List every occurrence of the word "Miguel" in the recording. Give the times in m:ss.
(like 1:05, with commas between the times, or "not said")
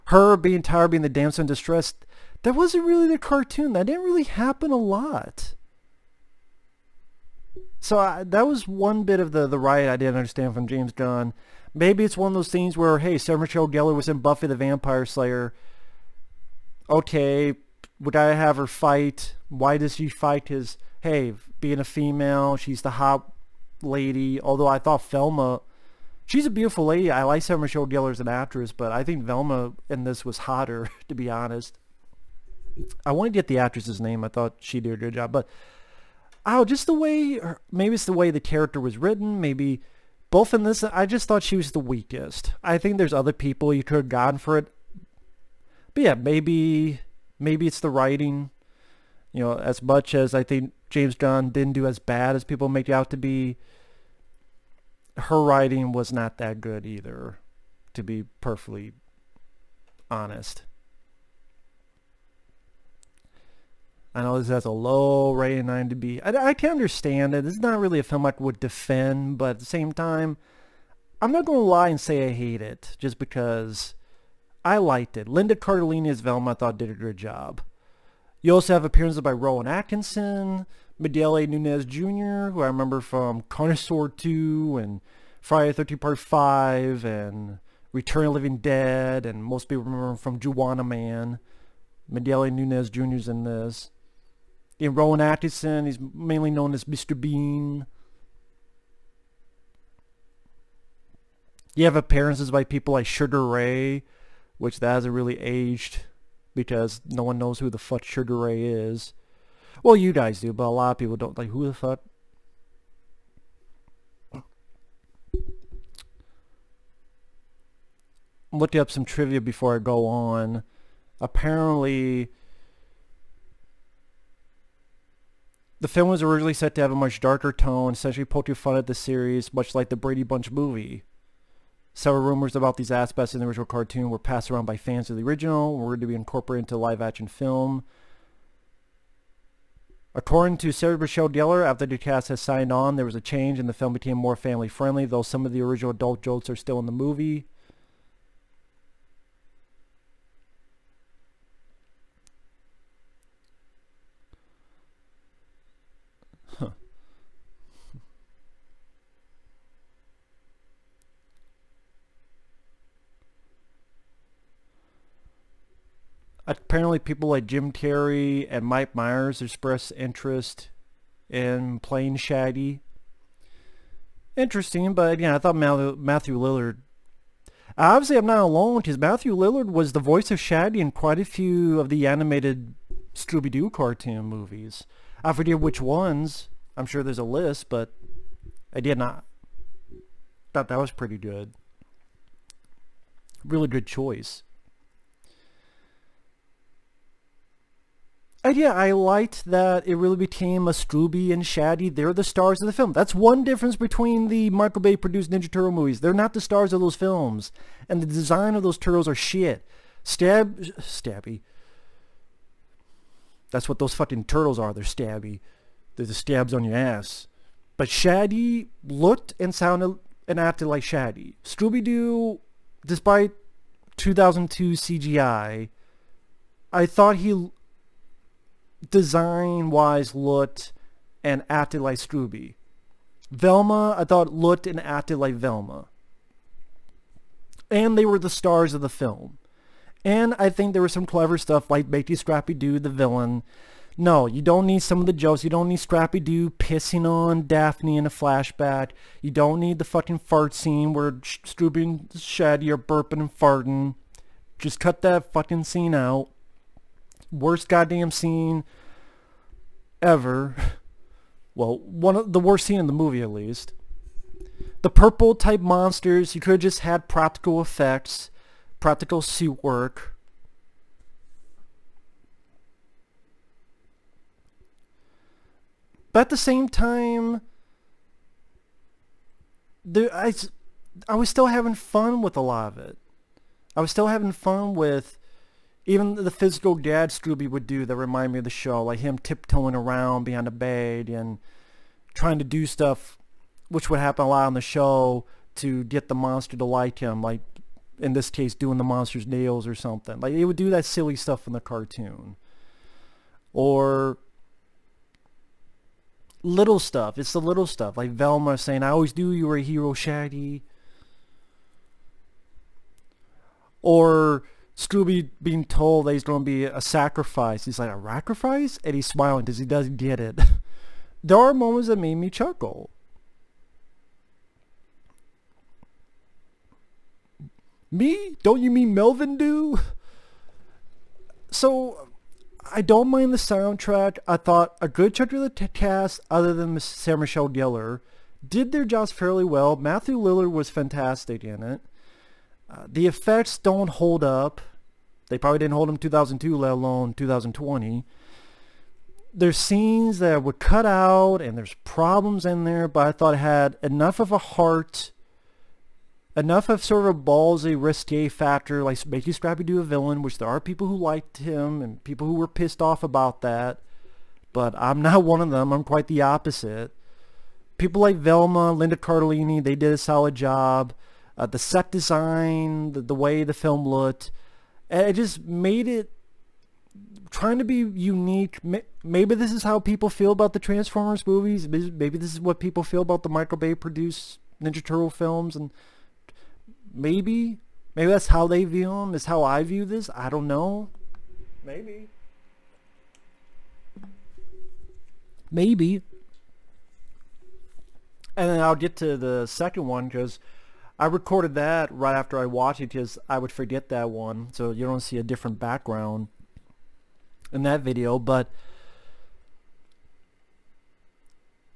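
1:20, 1:32.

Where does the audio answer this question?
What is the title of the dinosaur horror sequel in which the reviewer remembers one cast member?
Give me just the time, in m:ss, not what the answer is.
1:23.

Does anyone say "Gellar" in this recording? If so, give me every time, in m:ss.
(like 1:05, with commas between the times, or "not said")
0:13, 0:27, 2:21, 5:37.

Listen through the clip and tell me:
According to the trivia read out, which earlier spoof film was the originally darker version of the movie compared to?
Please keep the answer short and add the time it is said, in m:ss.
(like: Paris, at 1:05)
The Brady Bunch movie, at 2:09.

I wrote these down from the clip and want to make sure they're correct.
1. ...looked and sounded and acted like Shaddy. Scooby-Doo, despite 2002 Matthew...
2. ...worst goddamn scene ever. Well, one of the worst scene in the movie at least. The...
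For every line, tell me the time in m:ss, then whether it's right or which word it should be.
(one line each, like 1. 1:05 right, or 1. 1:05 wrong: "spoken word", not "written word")
1. 3:38 wrong: "CGI", not "Matthew"
2. 4:17 right.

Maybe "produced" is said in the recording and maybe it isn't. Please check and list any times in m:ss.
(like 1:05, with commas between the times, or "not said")
3:24, 6:23.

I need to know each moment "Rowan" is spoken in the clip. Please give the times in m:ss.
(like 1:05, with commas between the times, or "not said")
1:19, 1:34.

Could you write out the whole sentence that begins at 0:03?
That didn't really happen a lot.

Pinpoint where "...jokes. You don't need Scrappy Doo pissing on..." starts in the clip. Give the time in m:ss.
4:05.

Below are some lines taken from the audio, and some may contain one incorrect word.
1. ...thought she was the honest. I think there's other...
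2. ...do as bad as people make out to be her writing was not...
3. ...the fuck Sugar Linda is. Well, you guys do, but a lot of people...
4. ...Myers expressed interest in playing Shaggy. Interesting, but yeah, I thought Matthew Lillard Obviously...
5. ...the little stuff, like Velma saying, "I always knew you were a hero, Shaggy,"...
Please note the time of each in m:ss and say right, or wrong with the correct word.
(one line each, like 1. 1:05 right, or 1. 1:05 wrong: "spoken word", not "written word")
1. 0:41 wrong: "weakest", not "honest"
2. 0:51 right
3. 1:47 wrong: "Ray", not "Linda"
4. 2:48 right
5. 5:07 right.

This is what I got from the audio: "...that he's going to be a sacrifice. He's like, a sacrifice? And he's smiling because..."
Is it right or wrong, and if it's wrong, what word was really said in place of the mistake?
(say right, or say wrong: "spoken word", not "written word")
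right.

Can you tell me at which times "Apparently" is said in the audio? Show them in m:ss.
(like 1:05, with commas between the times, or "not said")
2:01, 2:46.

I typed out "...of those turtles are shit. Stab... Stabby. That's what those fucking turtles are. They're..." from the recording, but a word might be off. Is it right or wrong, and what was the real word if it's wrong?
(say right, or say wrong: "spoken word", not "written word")
right.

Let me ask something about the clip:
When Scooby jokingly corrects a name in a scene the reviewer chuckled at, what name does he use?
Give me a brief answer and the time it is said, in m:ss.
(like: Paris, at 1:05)
Melvin Doo, at 5:28.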